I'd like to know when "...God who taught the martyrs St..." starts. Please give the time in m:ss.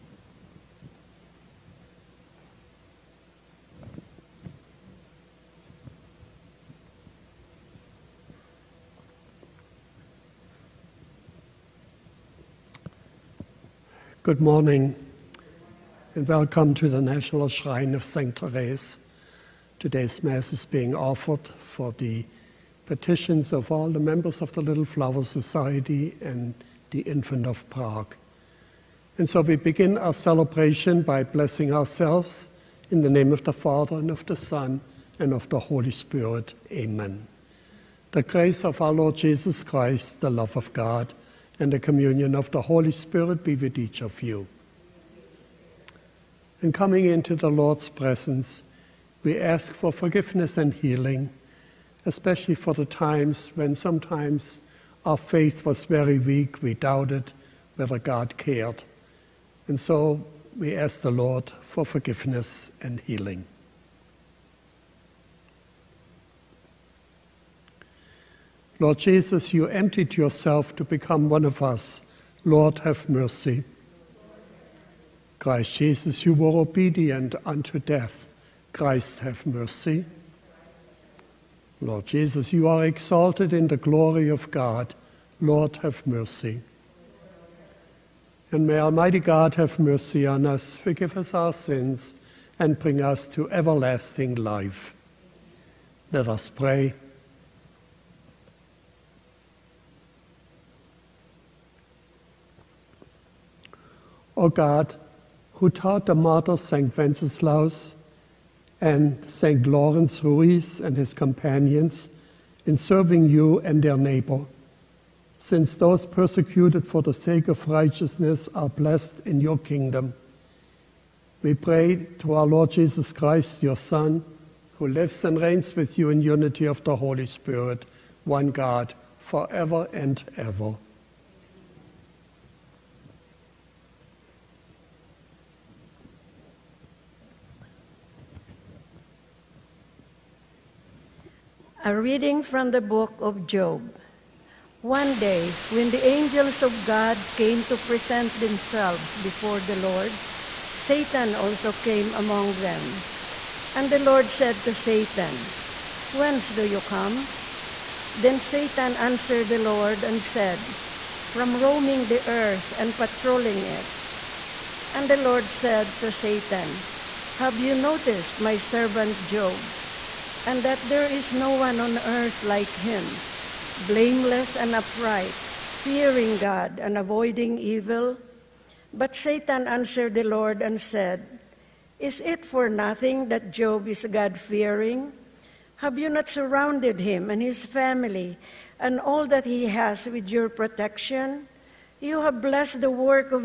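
1:44.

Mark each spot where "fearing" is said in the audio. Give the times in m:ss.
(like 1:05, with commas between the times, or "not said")
2:55, 3:04.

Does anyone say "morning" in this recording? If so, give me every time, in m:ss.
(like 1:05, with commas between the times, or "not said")
0:14.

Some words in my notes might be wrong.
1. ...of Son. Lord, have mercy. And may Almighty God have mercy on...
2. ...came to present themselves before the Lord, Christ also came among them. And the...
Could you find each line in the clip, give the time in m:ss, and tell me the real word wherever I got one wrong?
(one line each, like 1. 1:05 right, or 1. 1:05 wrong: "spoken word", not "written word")
1. 1:24 wrong: "God", not "Son"
2. 2:27 wrong: "Satan", not "Christ".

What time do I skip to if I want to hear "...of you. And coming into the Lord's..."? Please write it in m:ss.
0:44.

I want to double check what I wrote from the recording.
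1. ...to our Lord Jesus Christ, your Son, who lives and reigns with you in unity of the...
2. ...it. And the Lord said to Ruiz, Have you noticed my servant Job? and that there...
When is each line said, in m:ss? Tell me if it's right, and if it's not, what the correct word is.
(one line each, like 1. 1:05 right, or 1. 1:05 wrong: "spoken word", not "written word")
1. 2:02 right
2. 2:43 wrong: "Satan", not "Ruiz".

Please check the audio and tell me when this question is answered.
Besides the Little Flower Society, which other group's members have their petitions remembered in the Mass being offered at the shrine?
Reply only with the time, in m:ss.
0:27.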